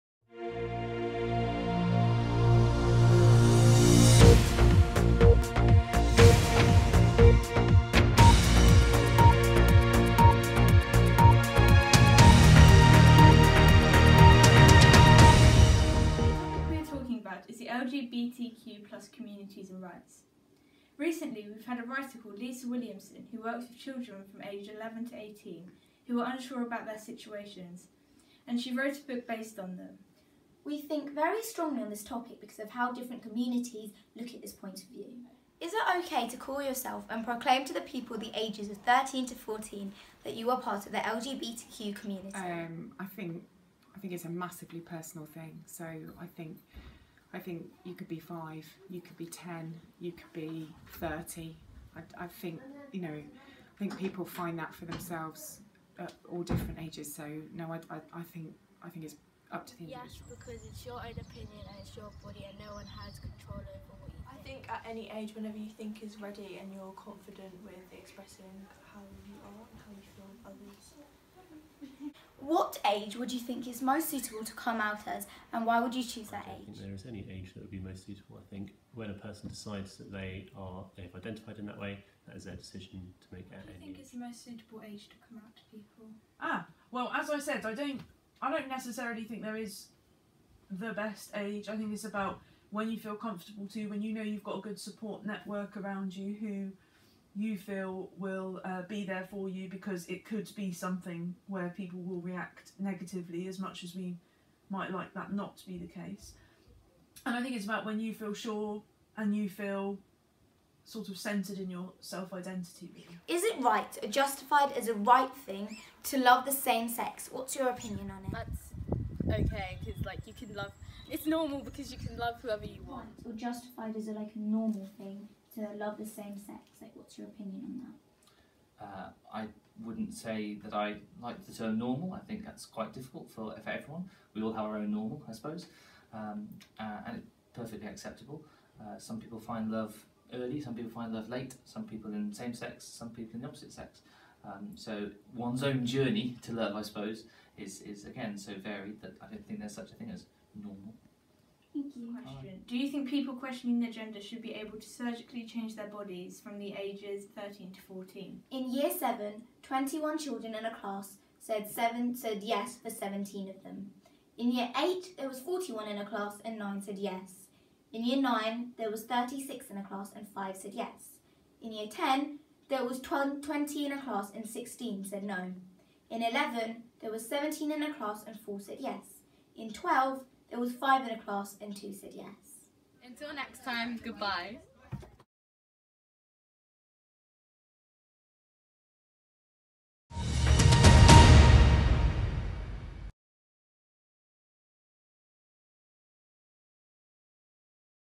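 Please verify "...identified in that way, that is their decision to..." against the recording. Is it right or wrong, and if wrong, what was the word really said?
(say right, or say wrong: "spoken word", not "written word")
right.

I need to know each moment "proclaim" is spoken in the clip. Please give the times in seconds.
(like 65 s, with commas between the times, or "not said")
37 s.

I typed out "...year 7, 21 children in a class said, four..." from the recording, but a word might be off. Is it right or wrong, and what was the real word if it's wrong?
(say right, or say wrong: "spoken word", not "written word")
wrong: "seven", not "four".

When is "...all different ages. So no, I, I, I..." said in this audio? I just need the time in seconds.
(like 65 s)
56 s.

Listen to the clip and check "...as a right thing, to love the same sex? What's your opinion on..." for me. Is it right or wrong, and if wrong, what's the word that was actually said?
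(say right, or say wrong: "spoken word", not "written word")
right.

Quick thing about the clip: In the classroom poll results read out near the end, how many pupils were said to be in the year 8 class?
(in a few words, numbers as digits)
41.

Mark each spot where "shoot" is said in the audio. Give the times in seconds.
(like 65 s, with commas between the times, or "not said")
not said.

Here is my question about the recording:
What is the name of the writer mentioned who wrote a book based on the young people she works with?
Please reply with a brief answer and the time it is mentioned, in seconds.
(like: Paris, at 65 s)
Lisa Williamson, at 22 s.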